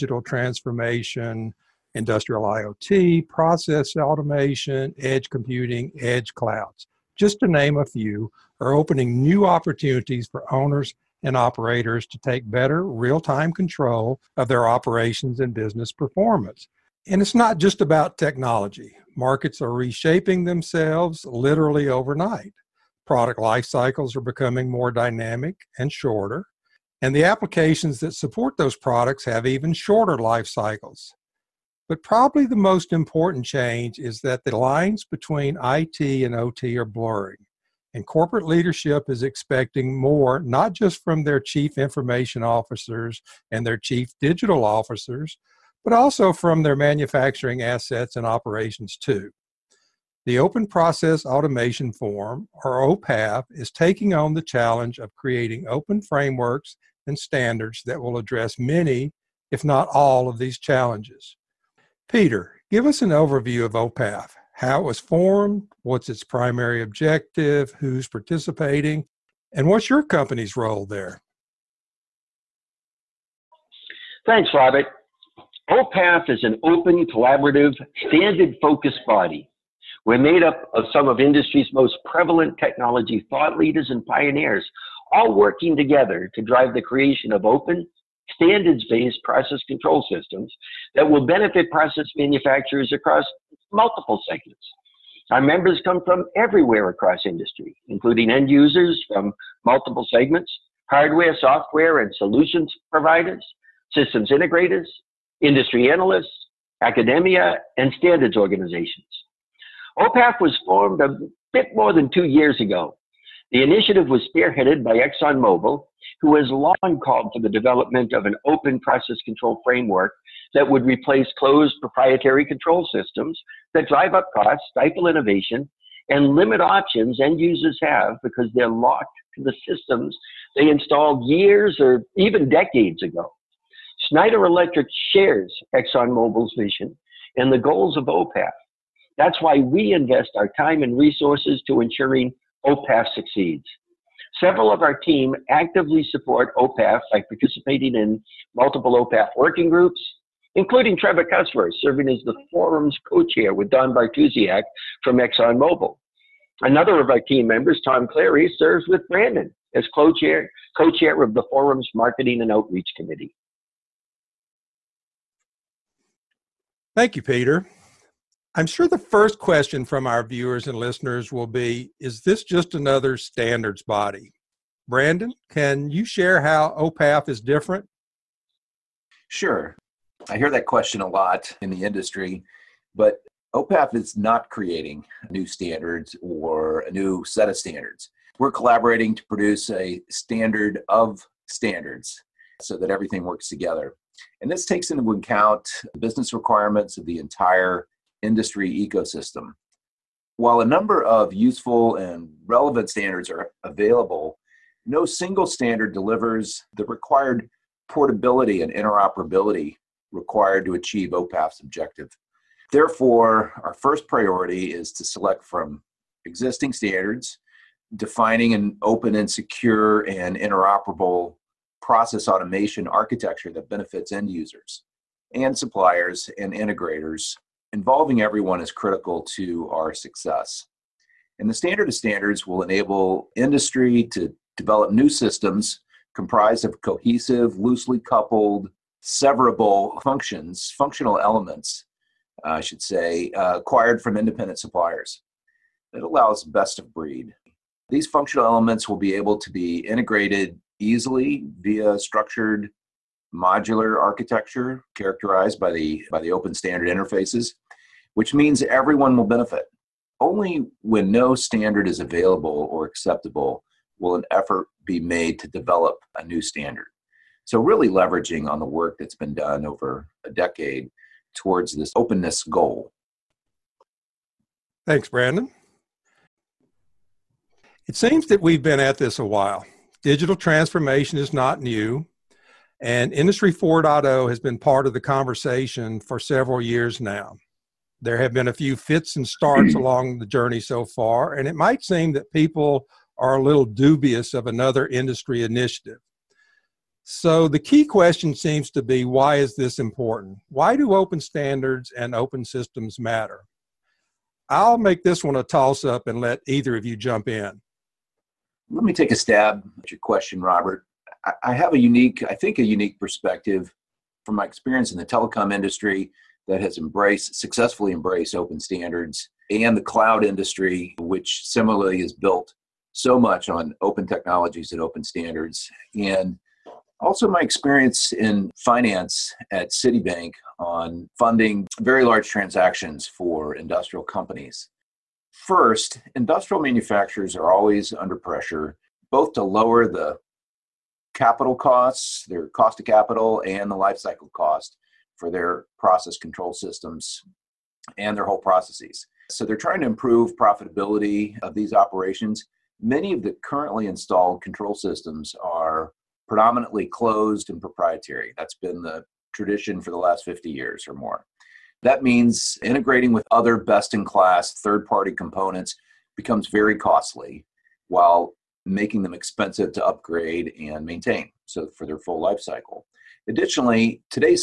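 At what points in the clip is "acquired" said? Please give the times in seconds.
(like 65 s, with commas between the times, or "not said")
243 s.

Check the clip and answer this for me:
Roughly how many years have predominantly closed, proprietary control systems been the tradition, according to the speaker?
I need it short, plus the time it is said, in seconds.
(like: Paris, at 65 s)
50 years, at 360 s.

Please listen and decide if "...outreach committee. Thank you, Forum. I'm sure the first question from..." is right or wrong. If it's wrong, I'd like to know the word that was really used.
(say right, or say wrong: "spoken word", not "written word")
wrong: "Peter", not "Forum".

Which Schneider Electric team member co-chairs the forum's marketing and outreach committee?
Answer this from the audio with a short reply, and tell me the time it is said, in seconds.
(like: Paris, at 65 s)
Tom Clary, at 157 s.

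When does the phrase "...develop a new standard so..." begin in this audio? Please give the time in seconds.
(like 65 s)
265 s.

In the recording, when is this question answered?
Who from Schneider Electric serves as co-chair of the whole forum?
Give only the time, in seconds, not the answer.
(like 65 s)
150 s.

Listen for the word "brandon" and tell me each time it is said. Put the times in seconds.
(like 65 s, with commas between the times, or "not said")
159 s, 174 s, 275 s.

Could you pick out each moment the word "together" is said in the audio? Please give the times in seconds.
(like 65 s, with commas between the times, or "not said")
85 s, 193 s.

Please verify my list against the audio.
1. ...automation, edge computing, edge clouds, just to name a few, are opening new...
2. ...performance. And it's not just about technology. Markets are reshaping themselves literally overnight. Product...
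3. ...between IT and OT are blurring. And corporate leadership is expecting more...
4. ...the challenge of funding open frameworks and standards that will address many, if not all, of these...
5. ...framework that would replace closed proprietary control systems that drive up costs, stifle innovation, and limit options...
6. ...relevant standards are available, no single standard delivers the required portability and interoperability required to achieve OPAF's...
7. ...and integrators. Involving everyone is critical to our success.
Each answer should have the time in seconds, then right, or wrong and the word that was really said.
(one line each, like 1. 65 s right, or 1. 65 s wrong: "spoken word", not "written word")
1. 3 s right
2. 15 s right
3. 35 s right
4. 54 s wrong: "creating", not "funding"
5. 119 s right
6. 202 s right
7. 226 s right.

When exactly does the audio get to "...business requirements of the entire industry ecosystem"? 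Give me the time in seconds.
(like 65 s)
195 s.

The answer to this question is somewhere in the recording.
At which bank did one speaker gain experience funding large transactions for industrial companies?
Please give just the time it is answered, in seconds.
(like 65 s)
329 s.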